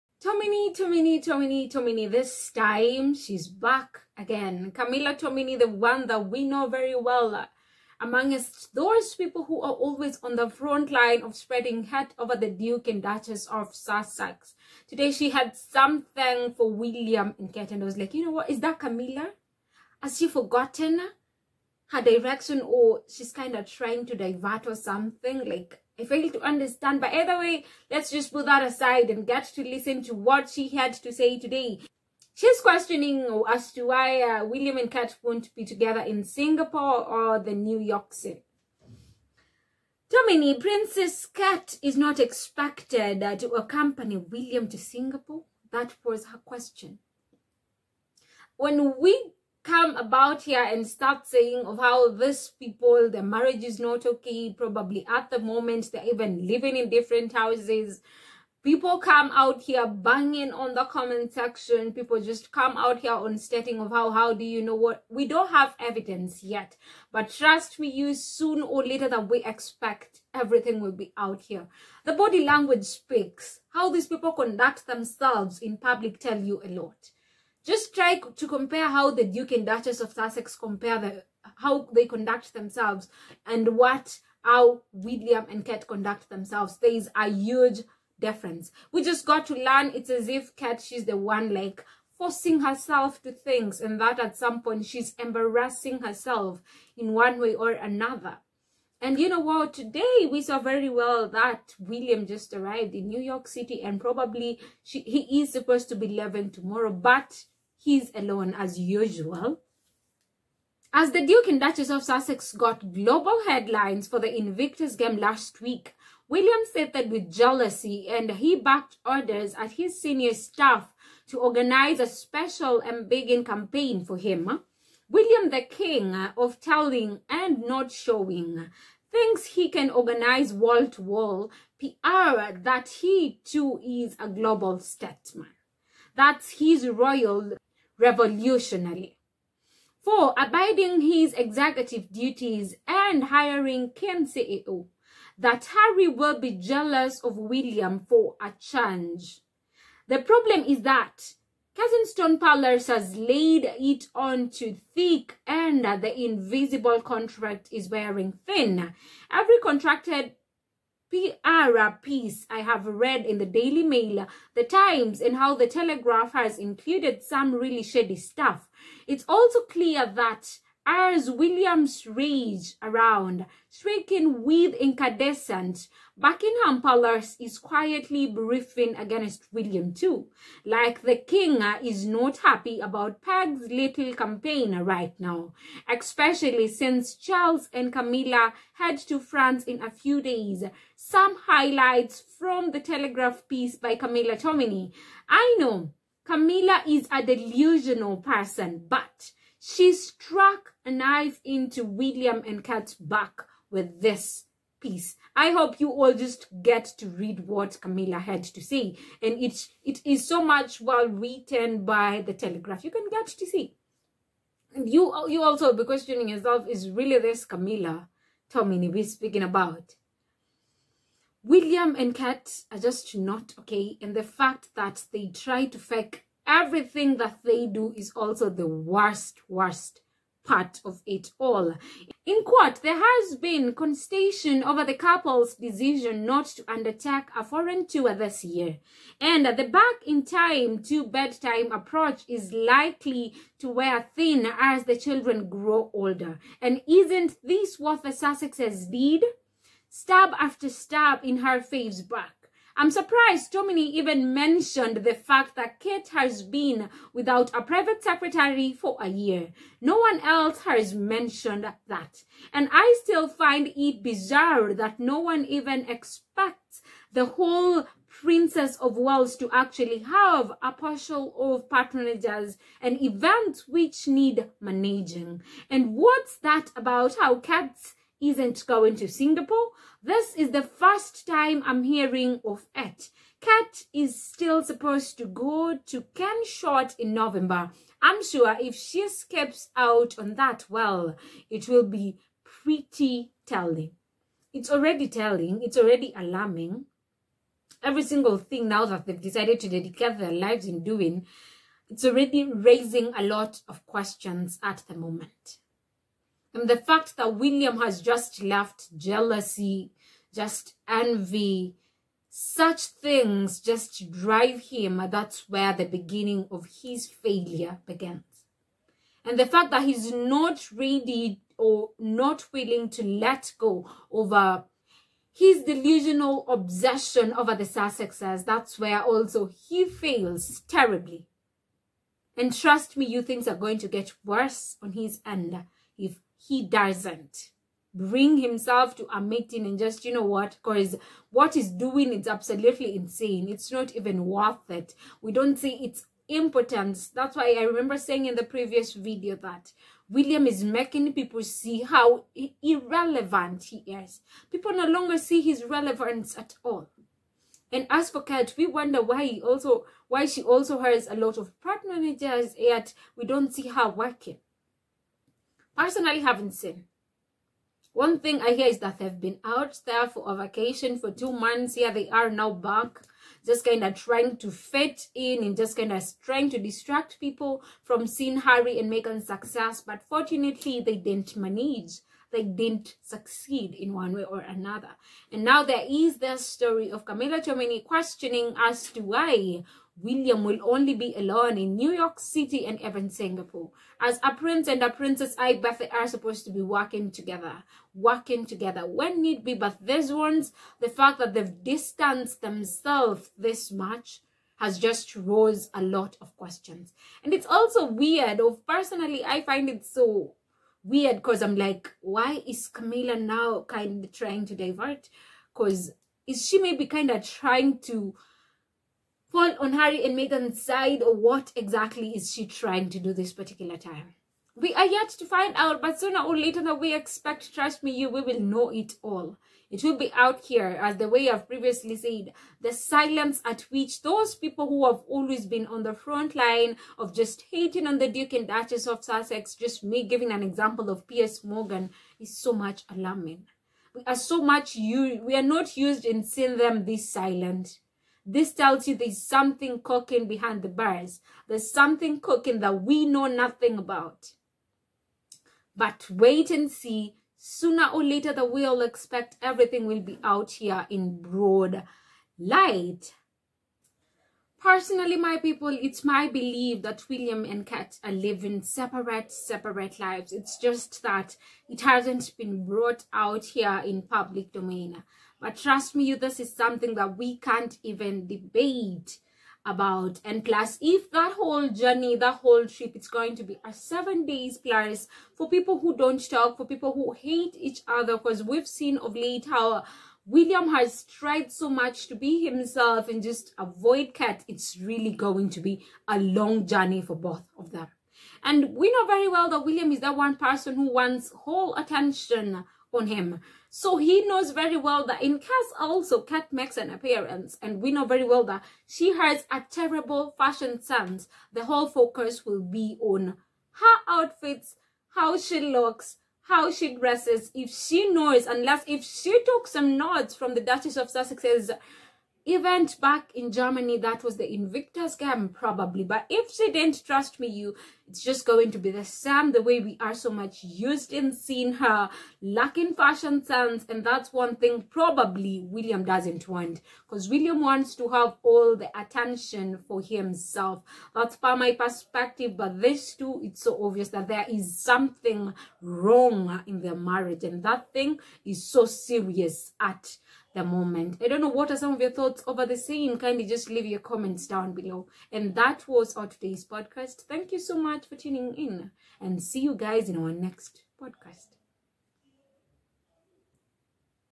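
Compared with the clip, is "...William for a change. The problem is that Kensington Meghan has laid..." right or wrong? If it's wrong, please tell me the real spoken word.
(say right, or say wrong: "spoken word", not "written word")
wrong: "Palace", not "Meghan".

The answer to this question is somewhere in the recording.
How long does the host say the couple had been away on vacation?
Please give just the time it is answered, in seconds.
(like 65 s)
371 s.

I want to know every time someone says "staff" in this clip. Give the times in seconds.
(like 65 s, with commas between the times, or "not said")
120 s.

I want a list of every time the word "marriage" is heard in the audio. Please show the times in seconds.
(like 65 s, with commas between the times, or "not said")
53 s, 546 s.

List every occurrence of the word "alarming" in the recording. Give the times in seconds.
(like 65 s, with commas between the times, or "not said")
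296 s, 442 s.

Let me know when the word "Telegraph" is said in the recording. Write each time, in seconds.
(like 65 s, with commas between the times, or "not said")
165 s, 192 s, 212 s.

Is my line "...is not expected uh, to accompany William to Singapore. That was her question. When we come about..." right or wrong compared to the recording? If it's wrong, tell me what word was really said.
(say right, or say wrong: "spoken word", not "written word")
right.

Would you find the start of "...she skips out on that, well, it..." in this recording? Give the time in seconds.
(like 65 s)
288 s.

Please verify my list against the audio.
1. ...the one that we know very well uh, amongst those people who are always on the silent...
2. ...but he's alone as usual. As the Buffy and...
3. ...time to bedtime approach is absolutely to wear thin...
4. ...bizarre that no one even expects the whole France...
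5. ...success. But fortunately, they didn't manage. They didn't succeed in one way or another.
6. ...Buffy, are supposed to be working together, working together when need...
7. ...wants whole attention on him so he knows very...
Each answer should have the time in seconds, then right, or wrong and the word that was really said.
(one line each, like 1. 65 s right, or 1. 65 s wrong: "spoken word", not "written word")
1. 5 s wrong: "front", not "silent"
2. 106 s wrong: "Duke", not "Buffy"
3. 240 s wrong: "likely", not "absolutely"
4. 264 s wrong: "Princess", not "France"
5. 379 s right
6. 395 s right
7. 500 s right.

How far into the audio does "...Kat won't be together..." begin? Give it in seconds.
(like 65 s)
34 s.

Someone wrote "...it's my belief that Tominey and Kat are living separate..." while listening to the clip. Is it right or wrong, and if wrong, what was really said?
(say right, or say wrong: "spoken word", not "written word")
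wrong: "William", not "Tominey".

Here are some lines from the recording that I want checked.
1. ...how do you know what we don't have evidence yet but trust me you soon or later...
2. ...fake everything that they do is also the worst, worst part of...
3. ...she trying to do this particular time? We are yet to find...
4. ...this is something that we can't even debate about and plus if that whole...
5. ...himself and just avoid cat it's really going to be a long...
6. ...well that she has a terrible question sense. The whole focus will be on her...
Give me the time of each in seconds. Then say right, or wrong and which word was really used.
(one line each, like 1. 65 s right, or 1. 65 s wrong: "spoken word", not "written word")
1. 64 s right
2. 225 s right
3. 422 s right
4. 476 s right
5. 492 s right
6. 508 s wrong: "fashion", not "question".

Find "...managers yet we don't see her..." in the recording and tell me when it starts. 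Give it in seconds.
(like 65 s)
361 s.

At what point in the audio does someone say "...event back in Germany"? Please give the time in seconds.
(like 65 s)
522 s.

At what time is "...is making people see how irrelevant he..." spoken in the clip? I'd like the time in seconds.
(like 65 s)
350 s.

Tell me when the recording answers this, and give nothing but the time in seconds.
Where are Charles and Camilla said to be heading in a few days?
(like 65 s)
189 s.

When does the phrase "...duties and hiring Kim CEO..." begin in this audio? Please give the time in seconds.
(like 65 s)
142 s.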